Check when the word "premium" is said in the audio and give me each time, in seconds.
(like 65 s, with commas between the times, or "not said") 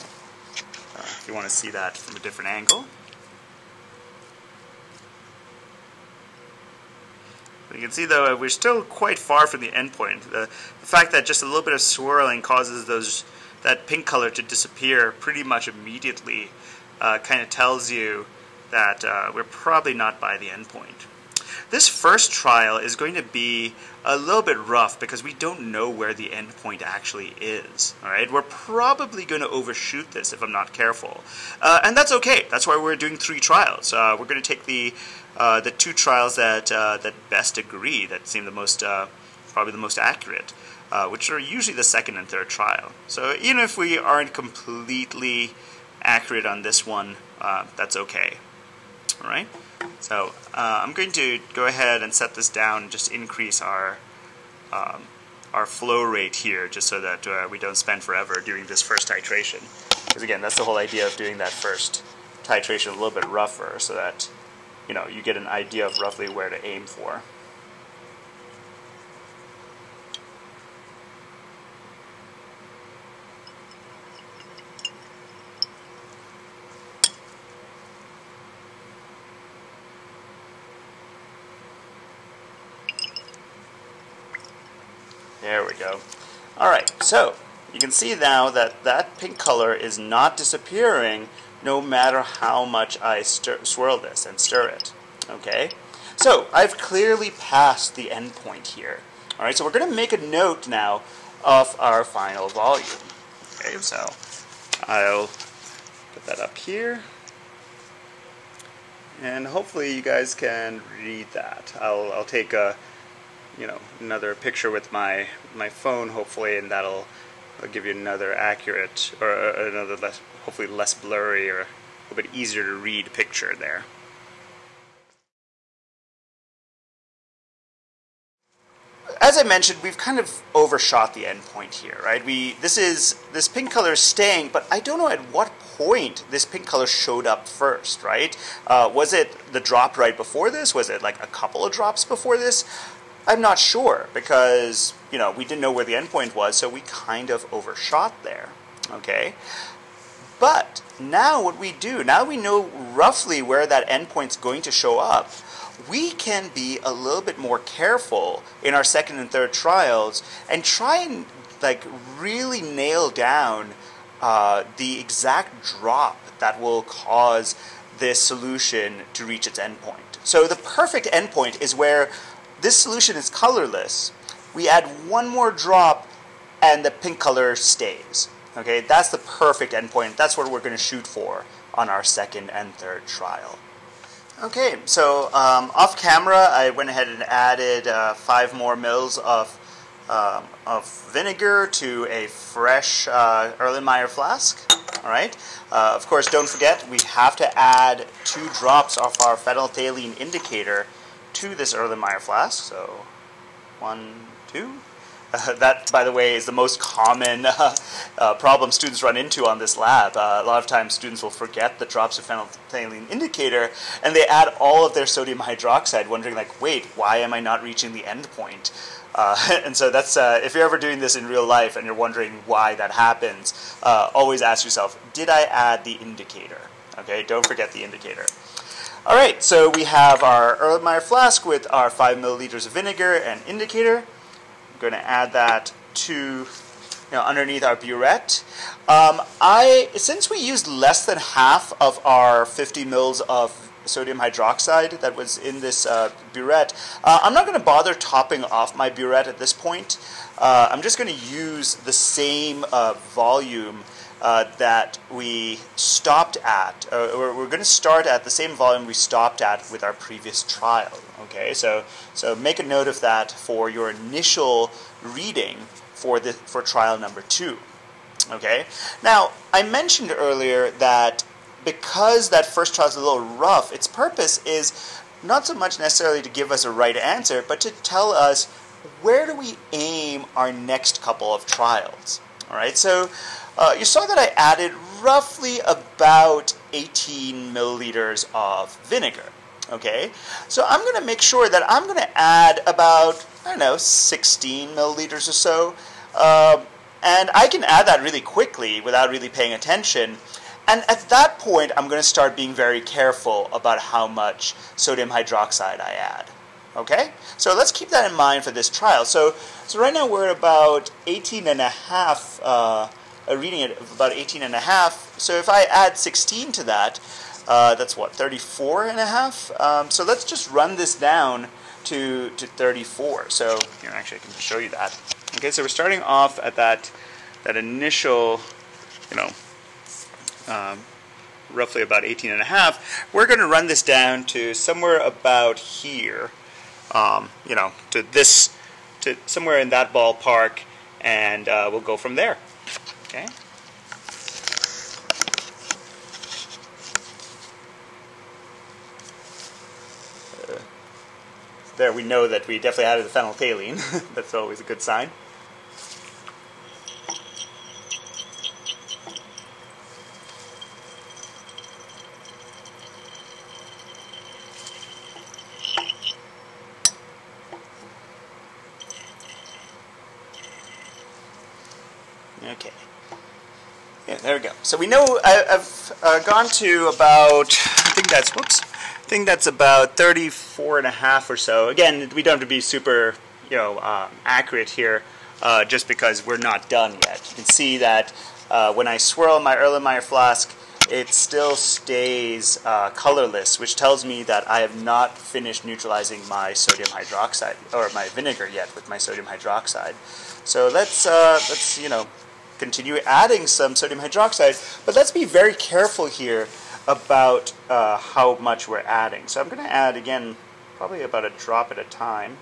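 not said.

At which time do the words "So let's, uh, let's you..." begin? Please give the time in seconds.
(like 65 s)
400 s.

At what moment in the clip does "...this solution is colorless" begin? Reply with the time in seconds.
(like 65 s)
172 s.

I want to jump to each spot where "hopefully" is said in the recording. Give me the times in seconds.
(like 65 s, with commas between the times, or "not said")
109 s, 116 s, 120 s.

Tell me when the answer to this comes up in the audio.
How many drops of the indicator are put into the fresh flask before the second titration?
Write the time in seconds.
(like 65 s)
198 s.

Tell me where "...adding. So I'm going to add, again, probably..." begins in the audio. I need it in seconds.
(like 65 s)
408 s.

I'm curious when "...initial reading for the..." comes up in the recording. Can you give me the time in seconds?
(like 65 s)
263 s.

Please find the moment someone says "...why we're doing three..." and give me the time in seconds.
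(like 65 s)
32 s.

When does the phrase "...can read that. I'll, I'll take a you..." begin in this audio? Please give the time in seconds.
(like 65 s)
110 s.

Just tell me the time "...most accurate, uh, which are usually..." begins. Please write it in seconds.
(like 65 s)
39 s.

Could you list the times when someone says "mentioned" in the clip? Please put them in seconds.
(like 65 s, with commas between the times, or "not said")
129 s, 269 s.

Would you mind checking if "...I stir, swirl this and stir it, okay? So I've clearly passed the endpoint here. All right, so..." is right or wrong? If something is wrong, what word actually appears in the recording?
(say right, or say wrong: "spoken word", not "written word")
right.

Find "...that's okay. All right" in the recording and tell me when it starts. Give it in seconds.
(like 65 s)
47 s.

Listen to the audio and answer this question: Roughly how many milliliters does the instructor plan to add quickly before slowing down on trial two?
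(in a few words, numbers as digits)
16 mL.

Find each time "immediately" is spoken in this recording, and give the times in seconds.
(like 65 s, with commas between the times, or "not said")
15 s.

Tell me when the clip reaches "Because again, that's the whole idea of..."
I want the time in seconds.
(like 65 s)
60 s.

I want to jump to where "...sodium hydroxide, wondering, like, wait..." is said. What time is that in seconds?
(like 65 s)
215 s.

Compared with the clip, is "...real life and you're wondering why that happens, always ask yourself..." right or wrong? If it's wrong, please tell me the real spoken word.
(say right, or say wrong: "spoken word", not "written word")
right.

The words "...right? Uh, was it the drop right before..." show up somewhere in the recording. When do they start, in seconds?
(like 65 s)
138 s.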